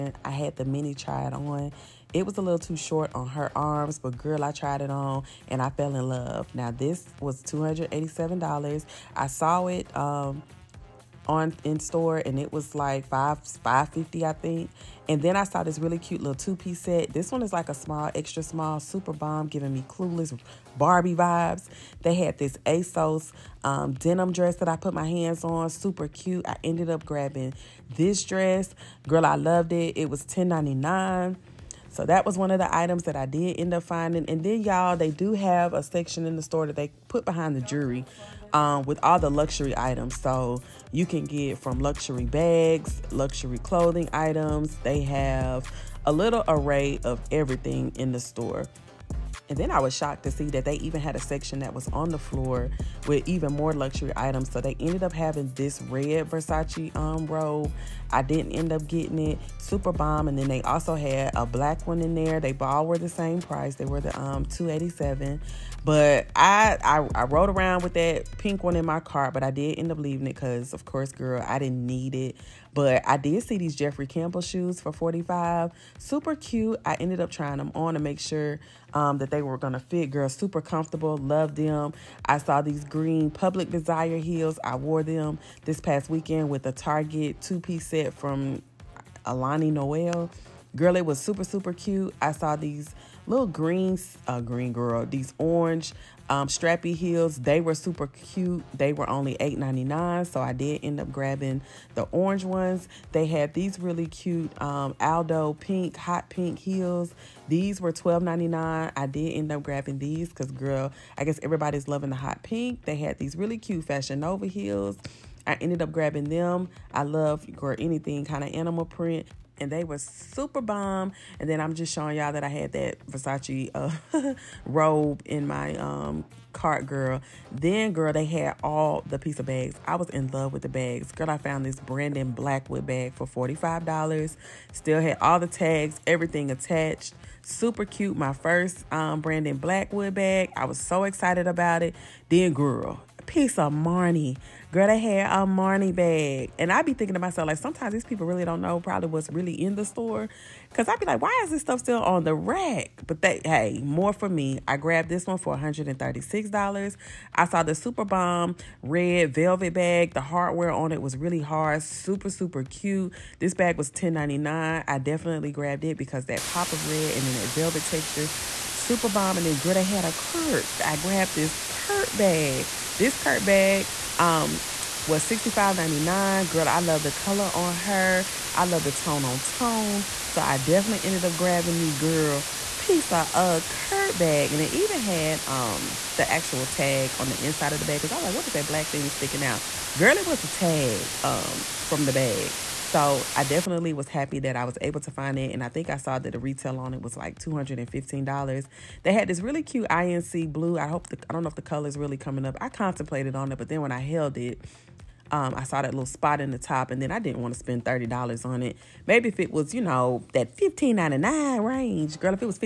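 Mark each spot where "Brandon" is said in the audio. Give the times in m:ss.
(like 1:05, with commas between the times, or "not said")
2:11, 2:19.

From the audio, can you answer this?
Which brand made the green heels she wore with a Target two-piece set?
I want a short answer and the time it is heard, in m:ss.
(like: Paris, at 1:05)
Public Desire, at 1:23.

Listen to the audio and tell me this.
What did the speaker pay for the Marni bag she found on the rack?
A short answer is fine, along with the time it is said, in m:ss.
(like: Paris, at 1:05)
$136, at 2:35.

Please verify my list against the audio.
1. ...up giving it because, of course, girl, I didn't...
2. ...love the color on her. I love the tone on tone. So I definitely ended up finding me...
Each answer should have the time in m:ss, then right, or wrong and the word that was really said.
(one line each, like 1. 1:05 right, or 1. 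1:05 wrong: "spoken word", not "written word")
1. 1:09 wrong: "leaving", not "giving"
2. 2:56 wrong: "grabbing", not "finding".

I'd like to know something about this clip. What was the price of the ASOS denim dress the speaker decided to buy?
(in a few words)
$10.99.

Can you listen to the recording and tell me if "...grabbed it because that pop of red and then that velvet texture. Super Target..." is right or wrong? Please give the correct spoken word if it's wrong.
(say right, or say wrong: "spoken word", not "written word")
wrong: "Bomb", not "Target".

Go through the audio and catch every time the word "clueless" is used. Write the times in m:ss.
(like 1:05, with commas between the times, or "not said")
0:19.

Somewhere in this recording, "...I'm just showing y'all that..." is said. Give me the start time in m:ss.
2:01.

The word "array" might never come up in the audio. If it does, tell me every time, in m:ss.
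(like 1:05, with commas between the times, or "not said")
0:46.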